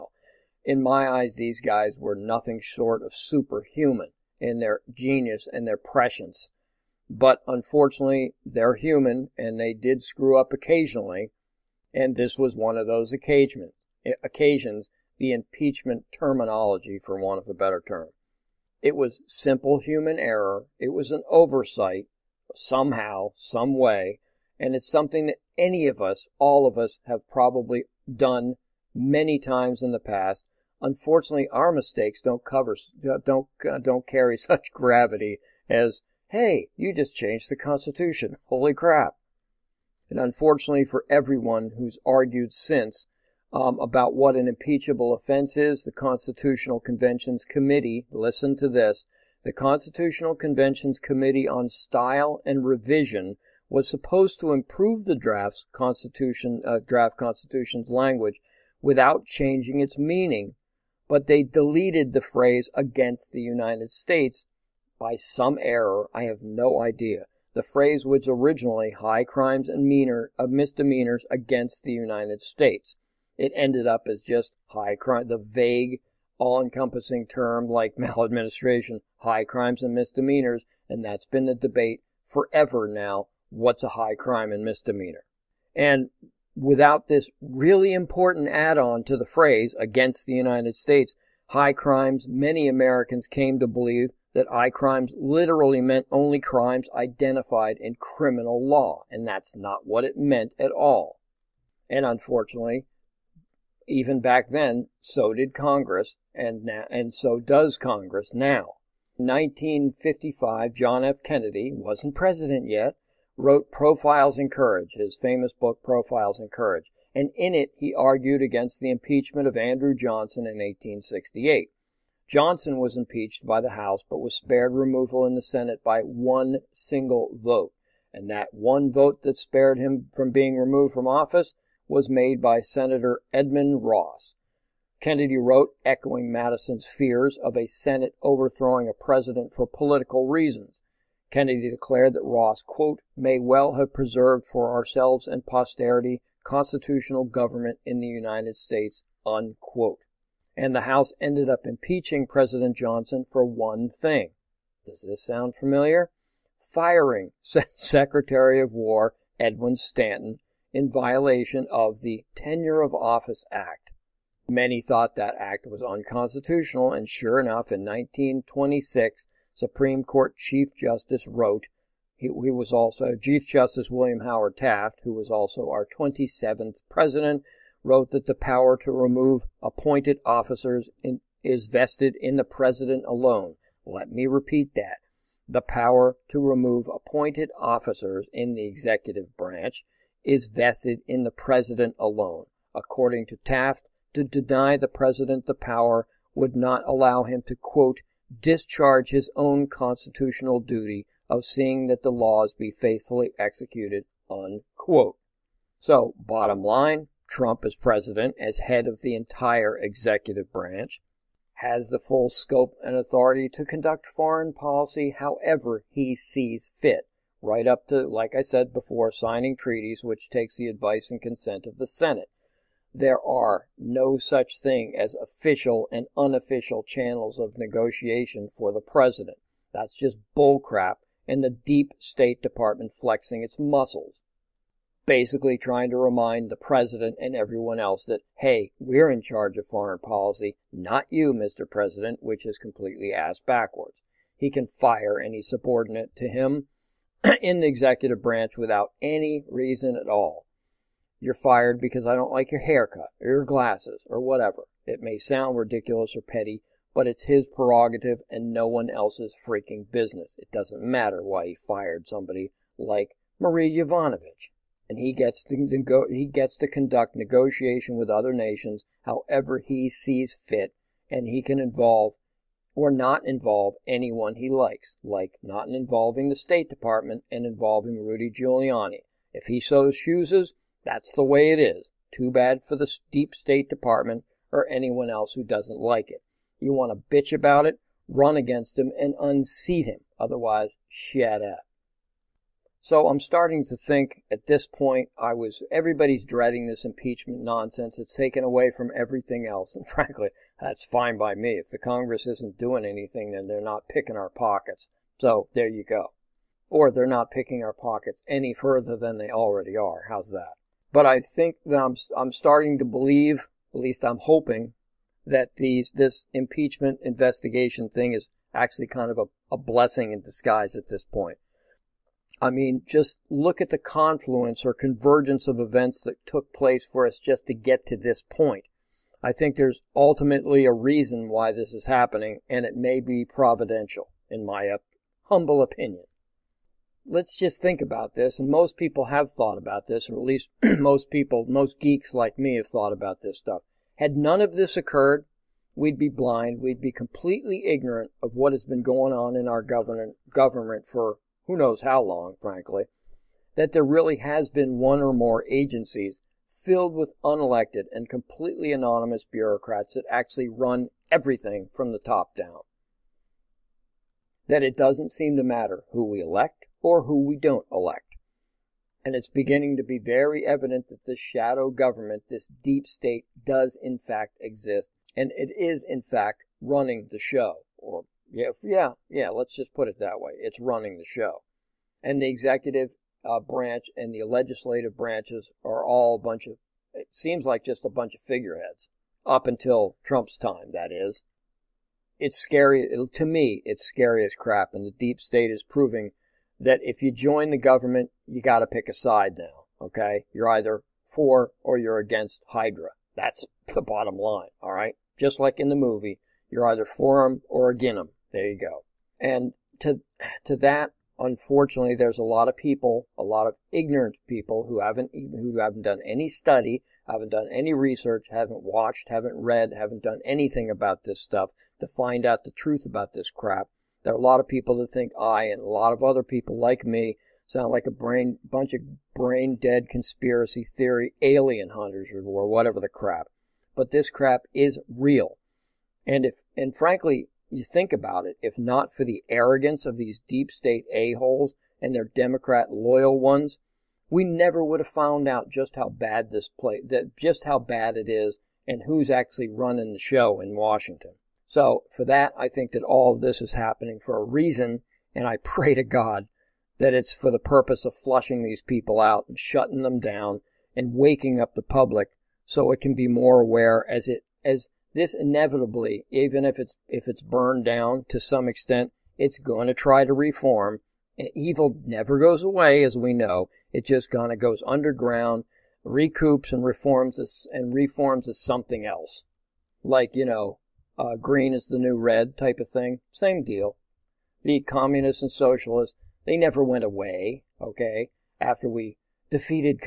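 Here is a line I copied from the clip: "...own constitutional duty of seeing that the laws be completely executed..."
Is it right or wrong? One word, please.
wrong.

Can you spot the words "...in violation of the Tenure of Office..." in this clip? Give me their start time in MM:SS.
02:40.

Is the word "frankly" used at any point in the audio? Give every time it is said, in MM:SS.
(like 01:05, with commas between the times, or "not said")
04:59, 05:52, 07:16.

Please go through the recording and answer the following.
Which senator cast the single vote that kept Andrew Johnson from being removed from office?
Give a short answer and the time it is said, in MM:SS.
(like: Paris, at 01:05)
Edmund Ross, at 02:13.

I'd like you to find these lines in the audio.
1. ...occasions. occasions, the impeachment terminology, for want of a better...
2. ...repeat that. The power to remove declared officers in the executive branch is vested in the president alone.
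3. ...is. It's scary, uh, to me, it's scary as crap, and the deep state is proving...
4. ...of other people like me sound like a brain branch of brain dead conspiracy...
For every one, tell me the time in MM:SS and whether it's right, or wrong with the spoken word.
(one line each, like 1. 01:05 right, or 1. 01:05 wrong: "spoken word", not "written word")
1. 00:13 right
2. 03:04 wrong: "appointed", not "declared"
3. 06:30 right
4. 07:05 wrong: "bunch", not "branch".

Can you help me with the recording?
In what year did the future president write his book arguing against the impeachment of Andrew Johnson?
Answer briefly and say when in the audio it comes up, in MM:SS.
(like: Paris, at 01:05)
1955, at 01:49.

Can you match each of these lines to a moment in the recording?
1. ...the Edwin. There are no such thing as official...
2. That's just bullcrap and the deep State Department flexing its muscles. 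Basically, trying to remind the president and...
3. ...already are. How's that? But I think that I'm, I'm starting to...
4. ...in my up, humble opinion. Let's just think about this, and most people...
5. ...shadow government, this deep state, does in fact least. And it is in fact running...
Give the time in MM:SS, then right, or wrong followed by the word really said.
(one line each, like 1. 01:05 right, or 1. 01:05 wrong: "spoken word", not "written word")
1. 03:41 wrong: "Senate", not "Edwin"
2. 03:49 right
3. 05:09 right
4. 05:34 right
5. 06:11 wrong: "exist", not "least".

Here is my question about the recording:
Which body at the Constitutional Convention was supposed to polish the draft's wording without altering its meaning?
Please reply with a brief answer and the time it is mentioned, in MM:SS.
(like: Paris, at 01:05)
committee on style and revision, at 00:50.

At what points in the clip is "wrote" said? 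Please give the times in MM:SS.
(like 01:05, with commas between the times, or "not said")
01:53, 02:15, 02:51, 02:57.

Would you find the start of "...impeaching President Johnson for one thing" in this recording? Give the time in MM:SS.
02:31.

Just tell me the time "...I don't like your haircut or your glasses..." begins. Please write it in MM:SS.
04:12.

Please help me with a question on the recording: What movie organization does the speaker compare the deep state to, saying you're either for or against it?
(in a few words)
Hydra.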